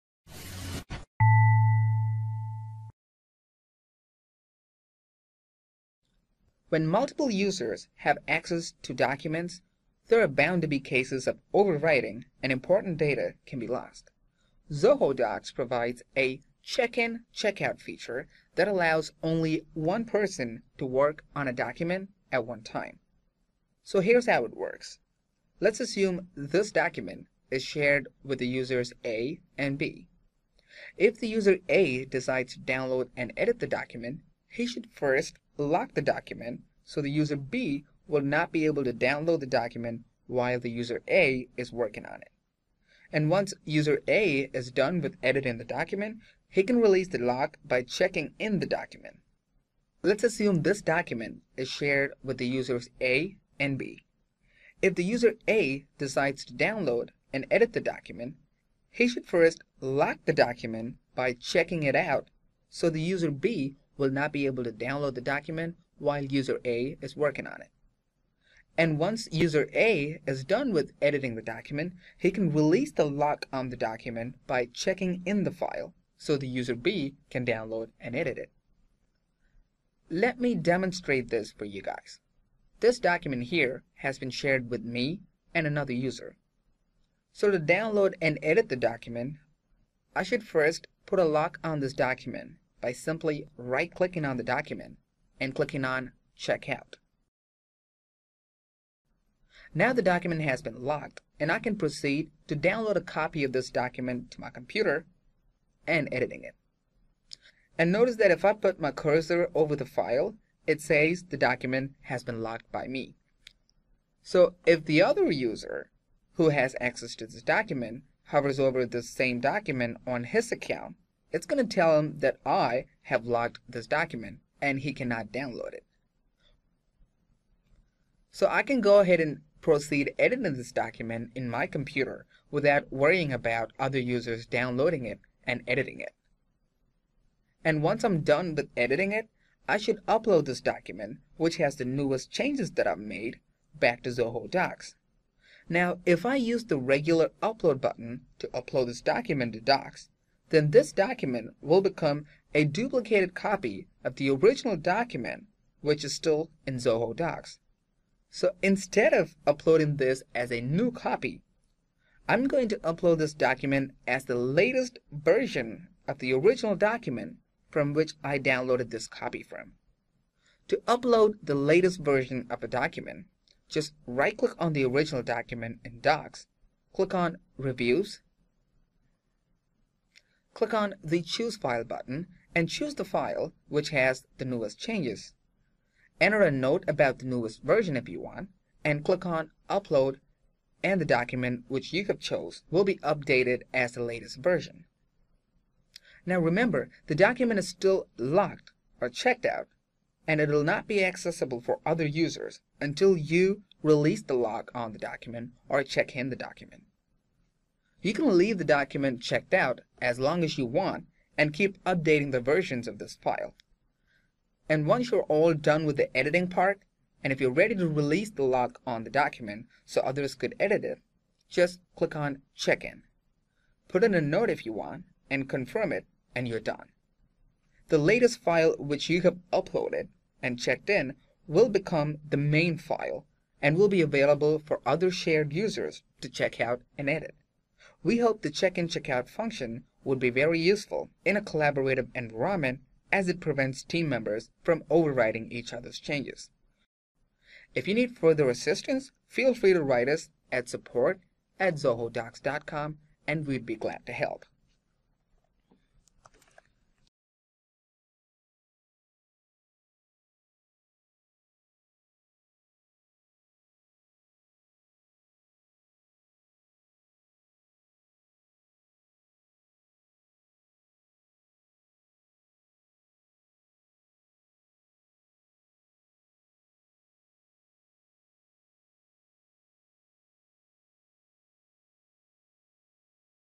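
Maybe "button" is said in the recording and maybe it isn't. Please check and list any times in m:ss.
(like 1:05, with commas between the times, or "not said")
2:27, 3:01.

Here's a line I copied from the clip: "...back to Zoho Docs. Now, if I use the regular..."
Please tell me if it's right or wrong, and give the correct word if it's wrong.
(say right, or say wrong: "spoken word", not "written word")
right.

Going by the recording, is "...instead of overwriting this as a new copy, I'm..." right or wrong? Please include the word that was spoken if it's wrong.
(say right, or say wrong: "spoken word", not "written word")
wrong: "uploading", not "overwriting".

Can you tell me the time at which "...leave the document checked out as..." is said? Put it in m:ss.
3:28.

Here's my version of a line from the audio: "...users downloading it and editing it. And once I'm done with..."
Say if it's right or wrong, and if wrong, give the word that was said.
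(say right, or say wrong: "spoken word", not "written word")
right.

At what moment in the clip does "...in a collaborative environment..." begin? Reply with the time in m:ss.
4:01.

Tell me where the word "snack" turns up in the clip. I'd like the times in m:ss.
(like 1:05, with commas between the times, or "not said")
not said.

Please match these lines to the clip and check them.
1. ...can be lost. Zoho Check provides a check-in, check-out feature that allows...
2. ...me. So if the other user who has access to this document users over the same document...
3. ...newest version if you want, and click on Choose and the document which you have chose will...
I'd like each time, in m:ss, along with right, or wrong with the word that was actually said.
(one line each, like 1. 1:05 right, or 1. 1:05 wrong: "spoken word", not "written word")
1. 0:13 wrong: "Docs", not "Check"
2. 1:52 wrong: "hovers", not "users"
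3. 3:07 wrong: "Upload", not "Choose".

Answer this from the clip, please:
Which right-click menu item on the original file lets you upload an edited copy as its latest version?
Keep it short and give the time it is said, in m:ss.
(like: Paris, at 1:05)
Reviews, at 2:57.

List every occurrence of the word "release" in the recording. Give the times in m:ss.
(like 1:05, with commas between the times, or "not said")
0:46, 1:12, 3:23, 3:37.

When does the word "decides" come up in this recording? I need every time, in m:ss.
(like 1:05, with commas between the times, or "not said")
0:32, 0:55.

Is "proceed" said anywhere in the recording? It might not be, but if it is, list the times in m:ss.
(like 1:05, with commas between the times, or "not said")
1:41, 2:09.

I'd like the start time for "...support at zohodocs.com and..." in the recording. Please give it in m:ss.
4:10.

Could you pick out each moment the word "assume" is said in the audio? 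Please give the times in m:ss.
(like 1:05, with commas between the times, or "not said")
0:25, 0:50.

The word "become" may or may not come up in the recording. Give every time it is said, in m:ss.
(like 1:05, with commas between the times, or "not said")
2:31, 3:51.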